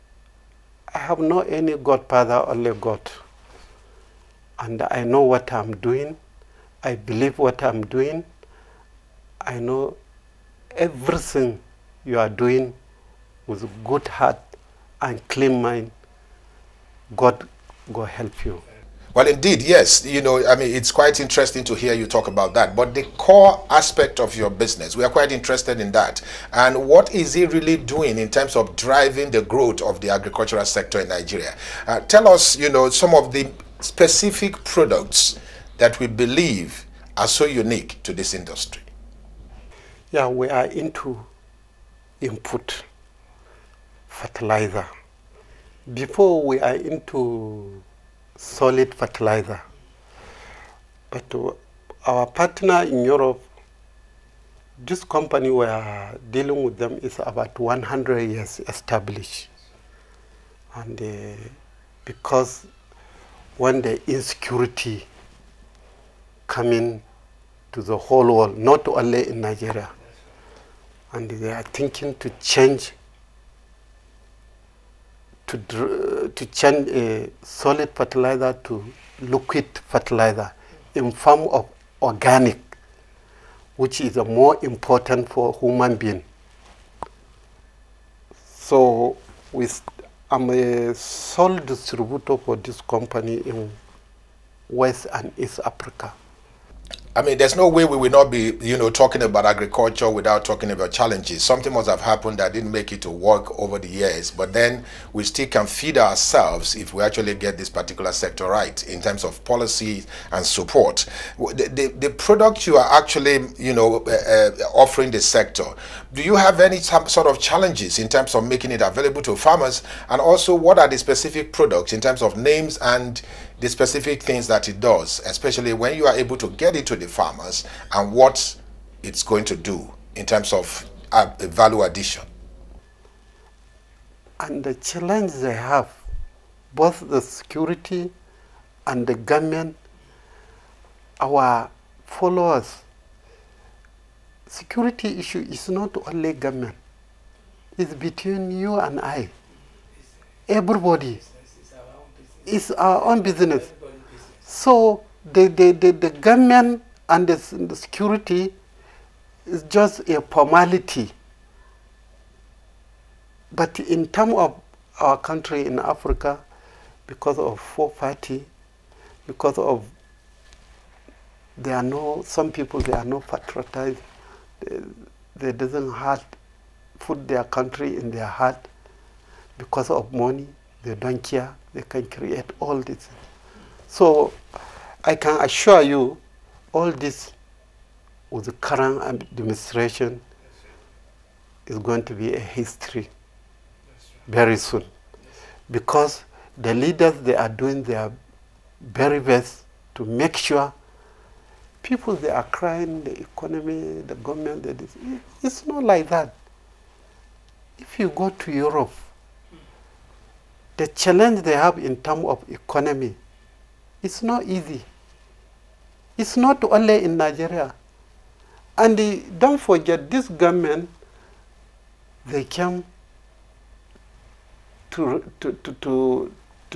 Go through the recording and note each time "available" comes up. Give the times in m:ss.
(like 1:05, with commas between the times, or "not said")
1:58.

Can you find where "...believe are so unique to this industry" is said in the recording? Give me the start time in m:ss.
0:36.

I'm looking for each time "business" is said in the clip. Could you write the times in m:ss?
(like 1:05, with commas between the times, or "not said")
0:24, 2:33.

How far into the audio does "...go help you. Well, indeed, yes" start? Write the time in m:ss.
0:17.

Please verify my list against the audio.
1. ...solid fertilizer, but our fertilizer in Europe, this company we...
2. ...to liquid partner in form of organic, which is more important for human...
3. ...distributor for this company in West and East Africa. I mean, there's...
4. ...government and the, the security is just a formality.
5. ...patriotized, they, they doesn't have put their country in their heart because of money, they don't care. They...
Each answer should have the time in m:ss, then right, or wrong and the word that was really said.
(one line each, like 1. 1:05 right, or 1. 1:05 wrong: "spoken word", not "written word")
1. 0:48 wrong: "partner", not "fertilizer"
2. 1:18 wrong: "fertilizer", not "partner"
3. 1:31 right
4. 2:36 right
5. 2:53 right.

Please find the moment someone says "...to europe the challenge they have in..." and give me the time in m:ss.
3:28.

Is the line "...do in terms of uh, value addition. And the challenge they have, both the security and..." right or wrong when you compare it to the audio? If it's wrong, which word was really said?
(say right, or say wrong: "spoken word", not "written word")
right.